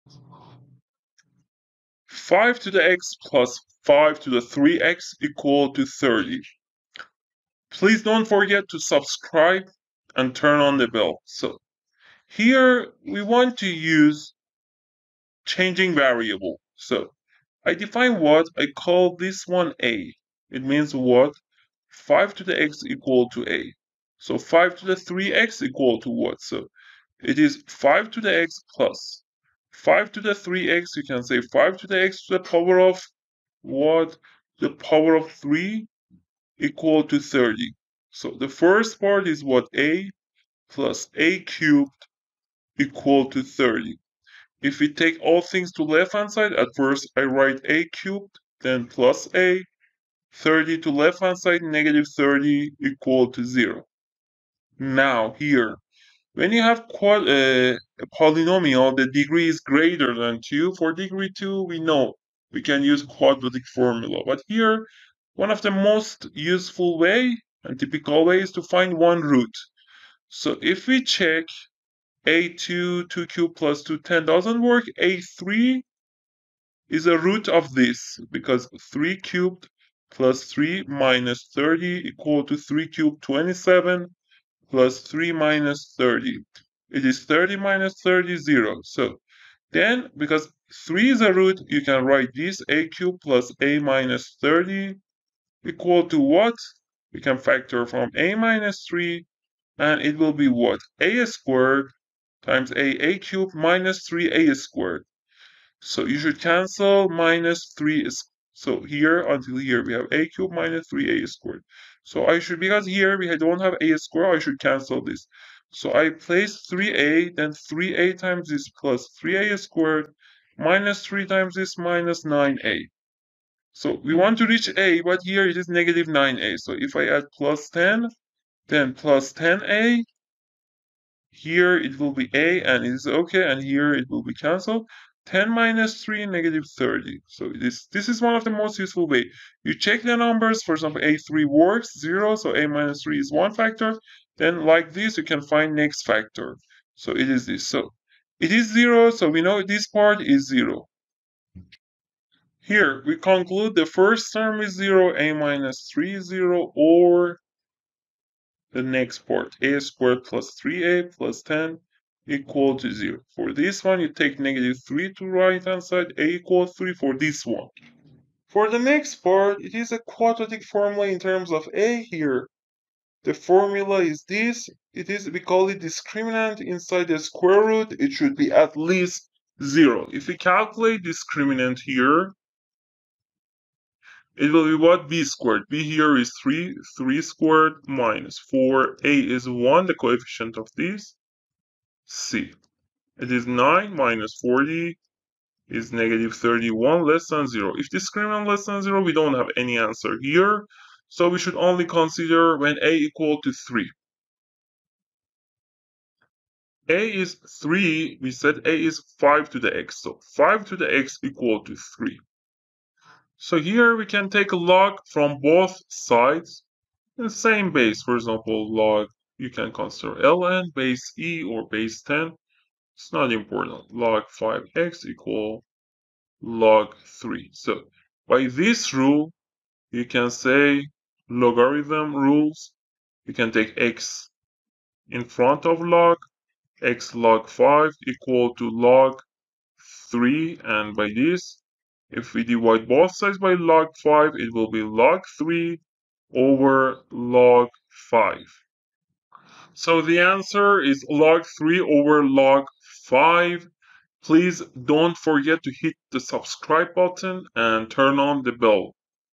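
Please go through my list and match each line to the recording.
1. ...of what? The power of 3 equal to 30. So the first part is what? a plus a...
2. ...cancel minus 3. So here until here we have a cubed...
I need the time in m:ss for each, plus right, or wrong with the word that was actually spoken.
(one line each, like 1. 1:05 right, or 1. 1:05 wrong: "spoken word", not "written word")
1. 0:32 right
2. 1:46 right.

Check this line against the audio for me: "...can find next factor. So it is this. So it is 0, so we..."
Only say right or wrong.
right.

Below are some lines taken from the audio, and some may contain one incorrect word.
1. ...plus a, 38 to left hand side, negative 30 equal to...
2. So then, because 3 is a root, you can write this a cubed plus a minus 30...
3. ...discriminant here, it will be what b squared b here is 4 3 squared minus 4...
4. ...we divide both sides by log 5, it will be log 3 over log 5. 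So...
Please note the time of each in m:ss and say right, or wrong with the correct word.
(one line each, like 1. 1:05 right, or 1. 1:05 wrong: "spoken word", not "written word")
1. 0:48 wrong: "30", not "38"
2. 1:28 right
3. 3:01 wrong: "3", not "4"
4. 4:02 right.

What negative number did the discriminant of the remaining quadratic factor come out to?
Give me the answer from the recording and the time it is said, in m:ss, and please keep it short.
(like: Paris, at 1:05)
-31, at 3:15.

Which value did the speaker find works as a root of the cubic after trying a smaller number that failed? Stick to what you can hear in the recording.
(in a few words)
3.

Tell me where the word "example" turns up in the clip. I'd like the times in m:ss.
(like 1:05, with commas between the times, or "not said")
2:20, 3:38.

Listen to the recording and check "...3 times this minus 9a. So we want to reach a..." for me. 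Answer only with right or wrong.
right.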